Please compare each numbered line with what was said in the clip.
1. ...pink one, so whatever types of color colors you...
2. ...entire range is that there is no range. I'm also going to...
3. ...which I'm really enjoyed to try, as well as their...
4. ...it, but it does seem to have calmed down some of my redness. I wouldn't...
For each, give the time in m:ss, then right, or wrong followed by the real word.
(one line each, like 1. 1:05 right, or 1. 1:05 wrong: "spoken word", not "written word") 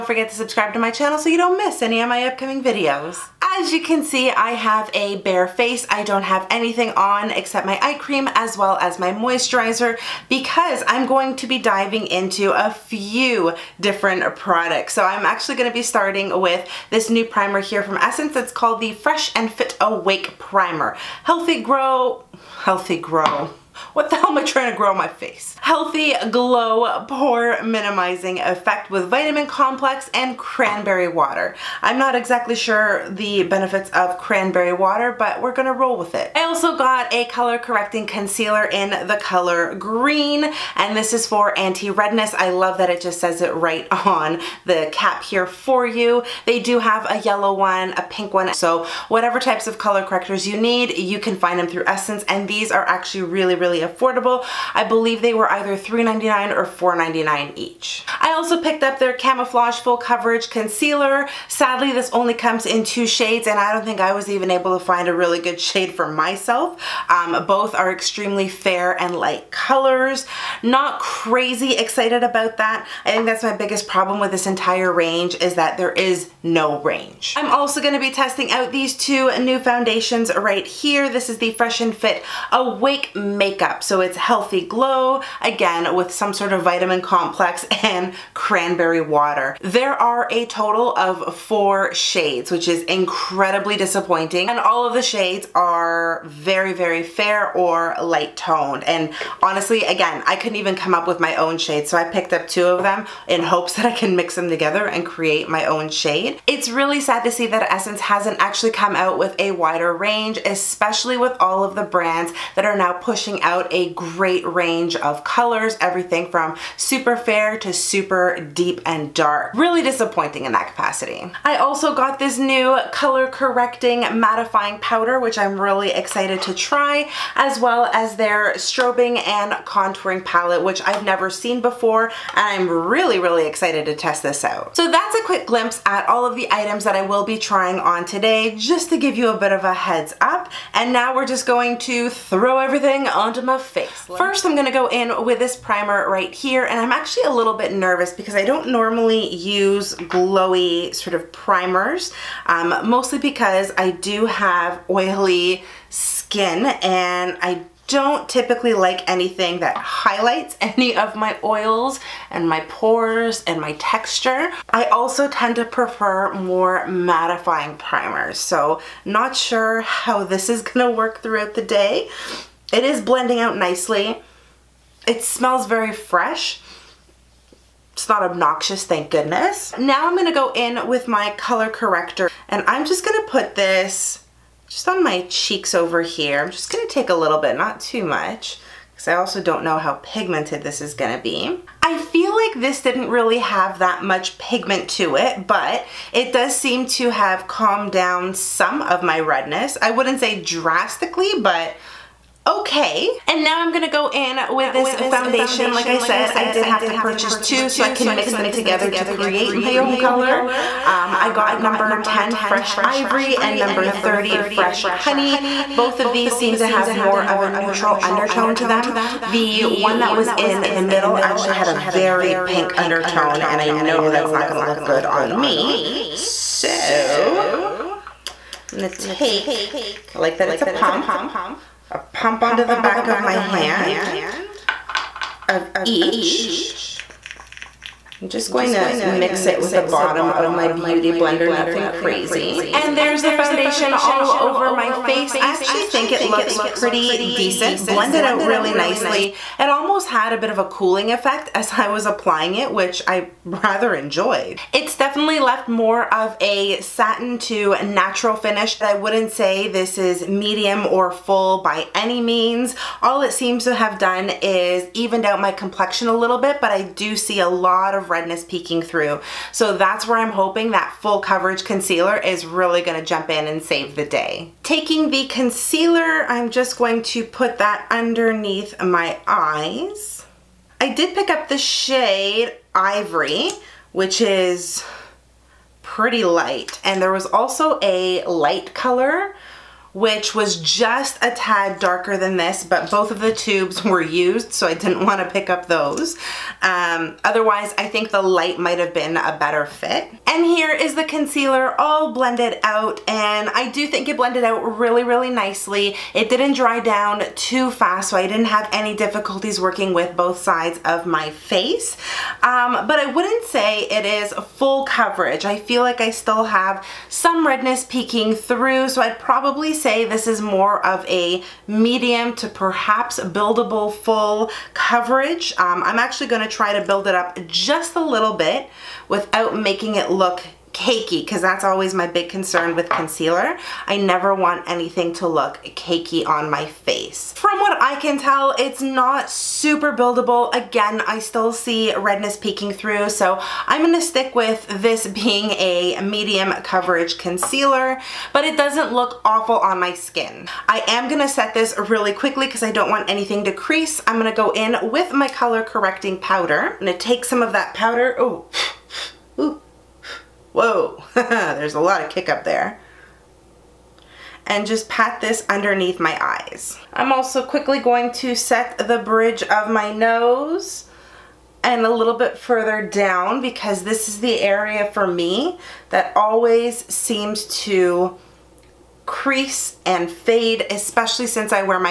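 1. 0:48 wrong: "correctors", not "colors"
2. 1:14 right
3. 2:05 wrong: "excited", not "enjoyed"
4. 3:15 right.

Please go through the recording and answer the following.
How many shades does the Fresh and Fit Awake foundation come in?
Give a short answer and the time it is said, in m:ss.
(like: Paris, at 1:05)
4, at 1:31.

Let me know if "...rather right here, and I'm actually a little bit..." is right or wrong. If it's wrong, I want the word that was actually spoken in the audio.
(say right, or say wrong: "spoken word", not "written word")
wrong: "primer", not "rather".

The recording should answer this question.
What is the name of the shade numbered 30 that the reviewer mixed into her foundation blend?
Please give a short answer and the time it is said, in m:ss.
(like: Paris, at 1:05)
Fresh Honey, at 3:34.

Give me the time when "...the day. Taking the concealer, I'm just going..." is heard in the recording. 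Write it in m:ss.
4:33.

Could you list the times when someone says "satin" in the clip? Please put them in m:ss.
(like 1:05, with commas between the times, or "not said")
4:16.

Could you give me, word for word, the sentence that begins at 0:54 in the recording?
I believe they were either $3.99 or $4.99 each.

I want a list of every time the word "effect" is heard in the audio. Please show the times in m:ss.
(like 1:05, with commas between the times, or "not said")
0:28, 4:11.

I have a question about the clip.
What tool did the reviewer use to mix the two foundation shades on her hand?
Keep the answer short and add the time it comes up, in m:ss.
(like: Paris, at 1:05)
Beauty Blender, at 4:00.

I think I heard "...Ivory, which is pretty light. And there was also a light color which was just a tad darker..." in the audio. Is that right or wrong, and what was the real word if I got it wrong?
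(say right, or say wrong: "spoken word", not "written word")
right.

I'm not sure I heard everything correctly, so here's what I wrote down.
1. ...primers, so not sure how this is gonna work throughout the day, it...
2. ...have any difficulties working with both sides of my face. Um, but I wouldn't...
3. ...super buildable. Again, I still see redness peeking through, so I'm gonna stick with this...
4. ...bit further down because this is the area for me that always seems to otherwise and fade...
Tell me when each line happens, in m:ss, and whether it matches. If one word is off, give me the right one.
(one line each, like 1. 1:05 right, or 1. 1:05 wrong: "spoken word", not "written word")
1. 2:47 right
2. 5:08 right
3. 5:39 right
4. 6:12 wrong: "crease", not "otherwise".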